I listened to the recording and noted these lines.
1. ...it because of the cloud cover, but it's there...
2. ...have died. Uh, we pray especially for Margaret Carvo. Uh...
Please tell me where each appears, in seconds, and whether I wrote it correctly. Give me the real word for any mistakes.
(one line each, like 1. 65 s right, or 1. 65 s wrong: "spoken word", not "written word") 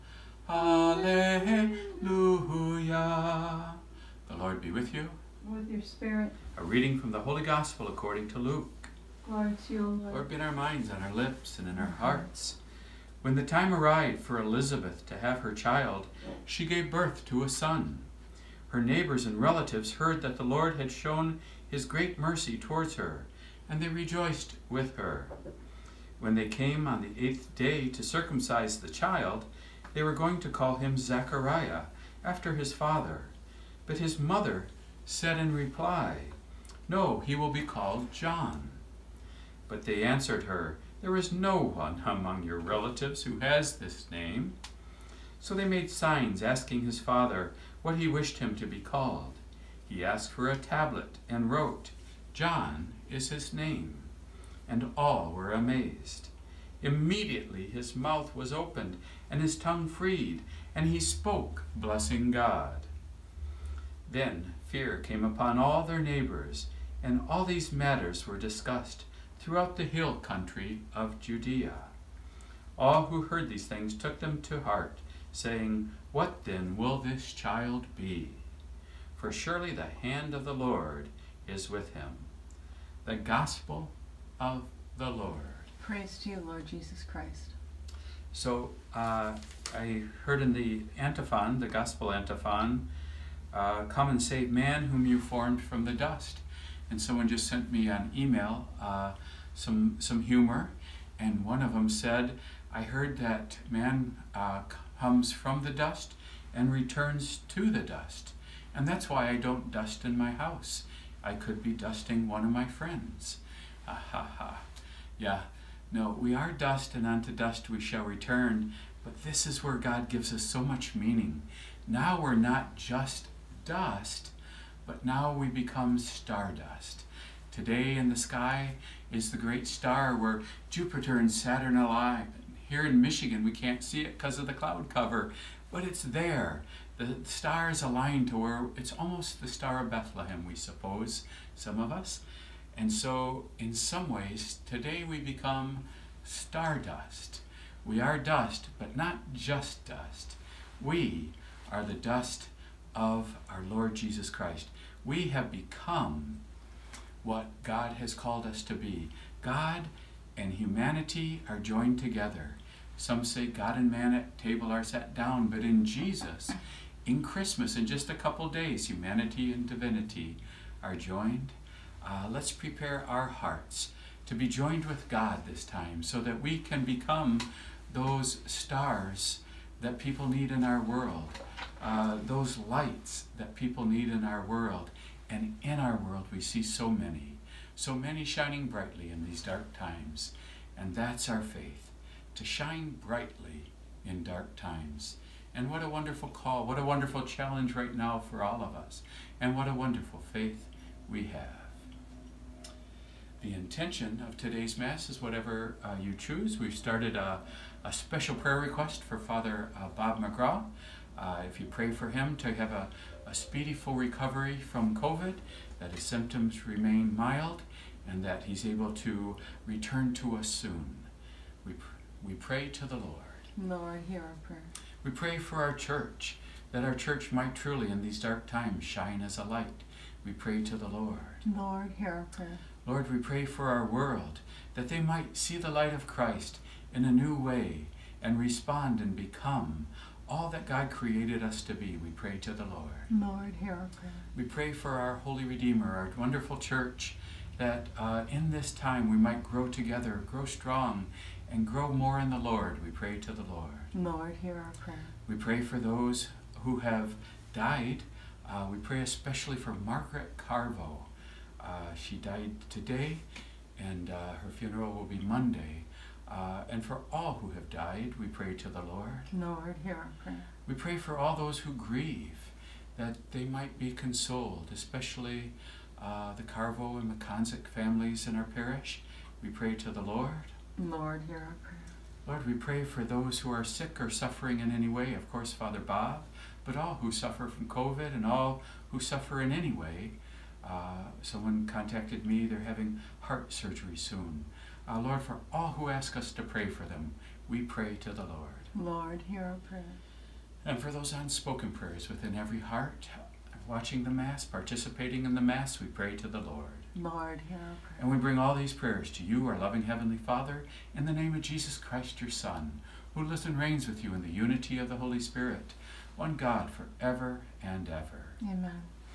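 1. 134 s right
2. 256 s right.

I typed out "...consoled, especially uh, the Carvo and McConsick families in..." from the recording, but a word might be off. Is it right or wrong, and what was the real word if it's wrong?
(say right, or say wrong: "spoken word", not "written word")
right.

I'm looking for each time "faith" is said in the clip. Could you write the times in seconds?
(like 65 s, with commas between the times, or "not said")
191 s, 200 s.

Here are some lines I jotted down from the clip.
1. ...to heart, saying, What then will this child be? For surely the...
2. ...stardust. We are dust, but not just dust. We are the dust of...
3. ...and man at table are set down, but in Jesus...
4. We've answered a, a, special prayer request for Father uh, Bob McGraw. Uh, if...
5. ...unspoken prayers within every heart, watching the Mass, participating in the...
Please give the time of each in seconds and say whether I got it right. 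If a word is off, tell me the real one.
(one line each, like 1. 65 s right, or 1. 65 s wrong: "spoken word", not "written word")
1. 74 s right
2. 146 s right
3. 163 s right
4. 206 s wrong: "started", not "answered"
5. 301 s right.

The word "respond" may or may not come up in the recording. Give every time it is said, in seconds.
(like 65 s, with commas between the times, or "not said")
238 s.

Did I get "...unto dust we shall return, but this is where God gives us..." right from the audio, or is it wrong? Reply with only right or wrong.
right.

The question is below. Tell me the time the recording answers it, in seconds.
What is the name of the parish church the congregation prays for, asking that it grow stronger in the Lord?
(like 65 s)
245 s.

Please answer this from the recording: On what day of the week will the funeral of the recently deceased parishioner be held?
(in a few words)
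Monday.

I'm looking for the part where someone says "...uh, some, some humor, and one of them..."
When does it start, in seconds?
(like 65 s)
98 s.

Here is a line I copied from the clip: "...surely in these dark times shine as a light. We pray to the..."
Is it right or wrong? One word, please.
wrong.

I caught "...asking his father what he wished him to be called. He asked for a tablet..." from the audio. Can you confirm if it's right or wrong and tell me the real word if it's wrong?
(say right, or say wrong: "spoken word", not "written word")
right.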